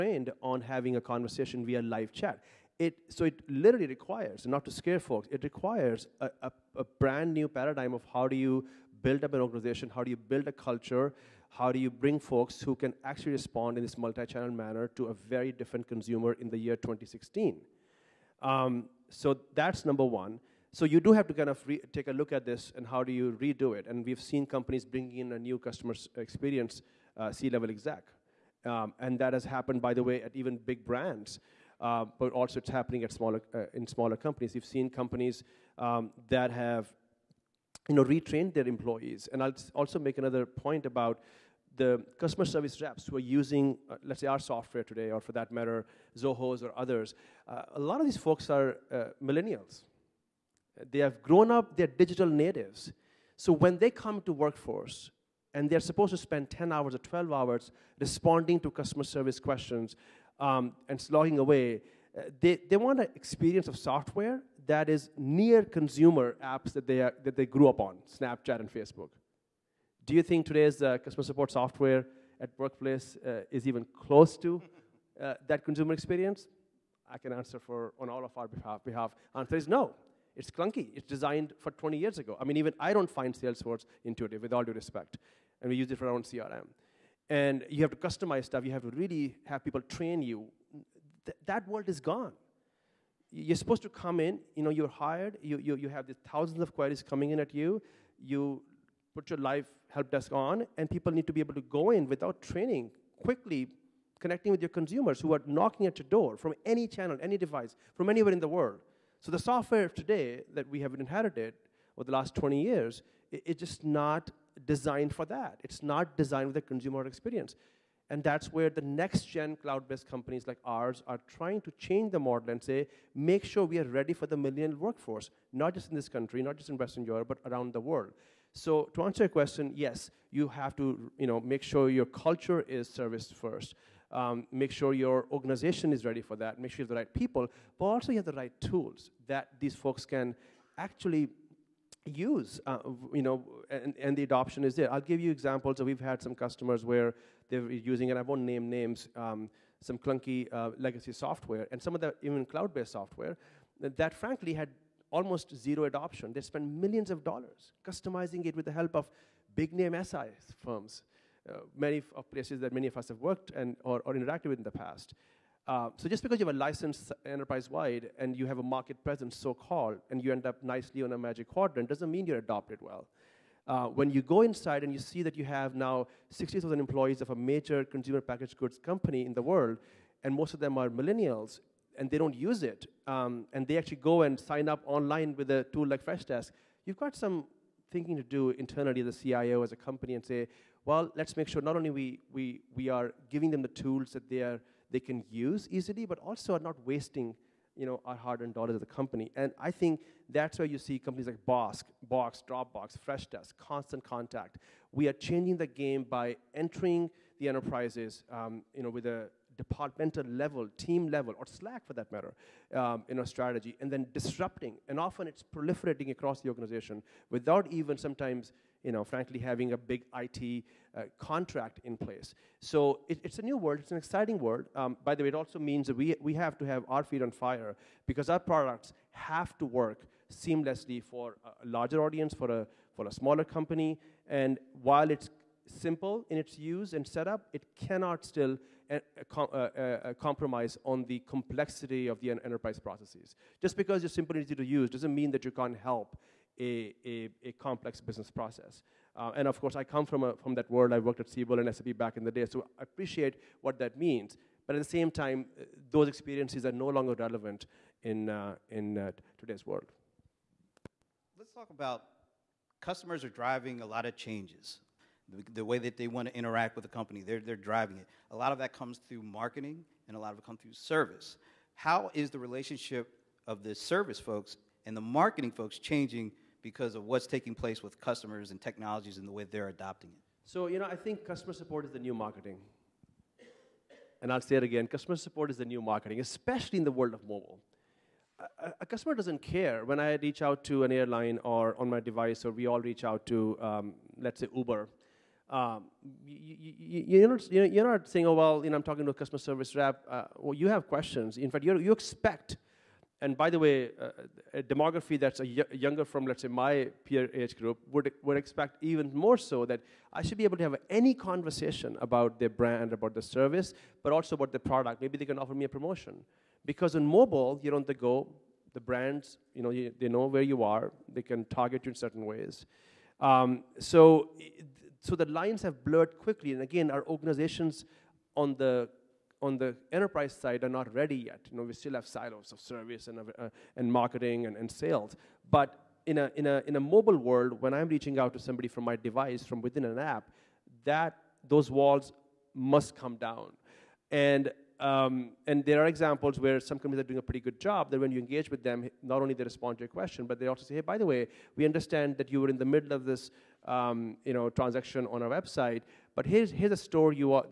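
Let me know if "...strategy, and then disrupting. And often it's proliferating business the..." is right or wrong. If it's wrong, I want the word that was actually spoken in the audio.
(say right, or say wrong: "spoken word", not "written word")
wrong: "across", not "business".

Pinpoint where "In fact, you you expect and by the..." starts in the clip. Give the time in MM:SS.
05:01.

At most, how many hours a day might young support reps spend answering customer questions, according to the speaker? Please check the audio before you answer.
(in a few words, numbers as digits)
12 hours.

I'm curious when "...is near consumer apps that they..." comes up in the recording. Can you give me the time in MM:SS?
01:04.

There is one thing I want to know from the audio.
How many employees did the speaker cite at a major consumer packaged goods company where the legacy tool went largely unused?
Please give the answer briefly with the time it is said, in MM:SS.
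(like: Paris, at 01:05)
60,000, at 02:56.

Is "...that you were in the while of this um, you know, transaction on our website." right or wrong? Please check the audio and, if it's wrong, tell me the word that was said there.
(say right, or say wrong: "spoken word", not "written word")
wrong: "middle", not "while".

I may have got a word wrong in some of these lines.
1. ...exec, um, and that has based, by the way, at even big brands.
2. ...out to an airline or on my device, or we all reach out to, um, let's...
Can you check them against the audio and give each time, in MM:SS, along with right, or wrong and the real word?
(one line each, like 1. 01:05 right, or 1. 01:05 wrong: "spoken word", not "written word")
1. 00:27 wrong: "happened", not "based"
2. 04:50 right.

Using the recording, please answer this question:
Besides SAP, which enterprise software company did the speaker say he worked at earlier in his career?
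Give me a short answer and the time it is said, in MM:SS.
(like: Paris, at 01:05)
Siebel, at 04:11.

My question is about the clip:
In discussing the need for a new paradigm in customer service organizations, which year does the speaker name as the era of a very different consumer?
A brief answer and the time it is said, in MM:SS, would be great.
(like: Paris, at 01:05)
2016, at 00:16.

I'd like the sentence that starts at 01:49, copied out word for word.
So the software of today that we have inherited over the last 20 years, it, it's just not designed for that.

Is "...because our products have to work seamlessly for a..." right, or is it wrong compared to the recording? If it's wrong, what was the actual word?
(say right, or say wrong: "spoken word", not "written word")
right.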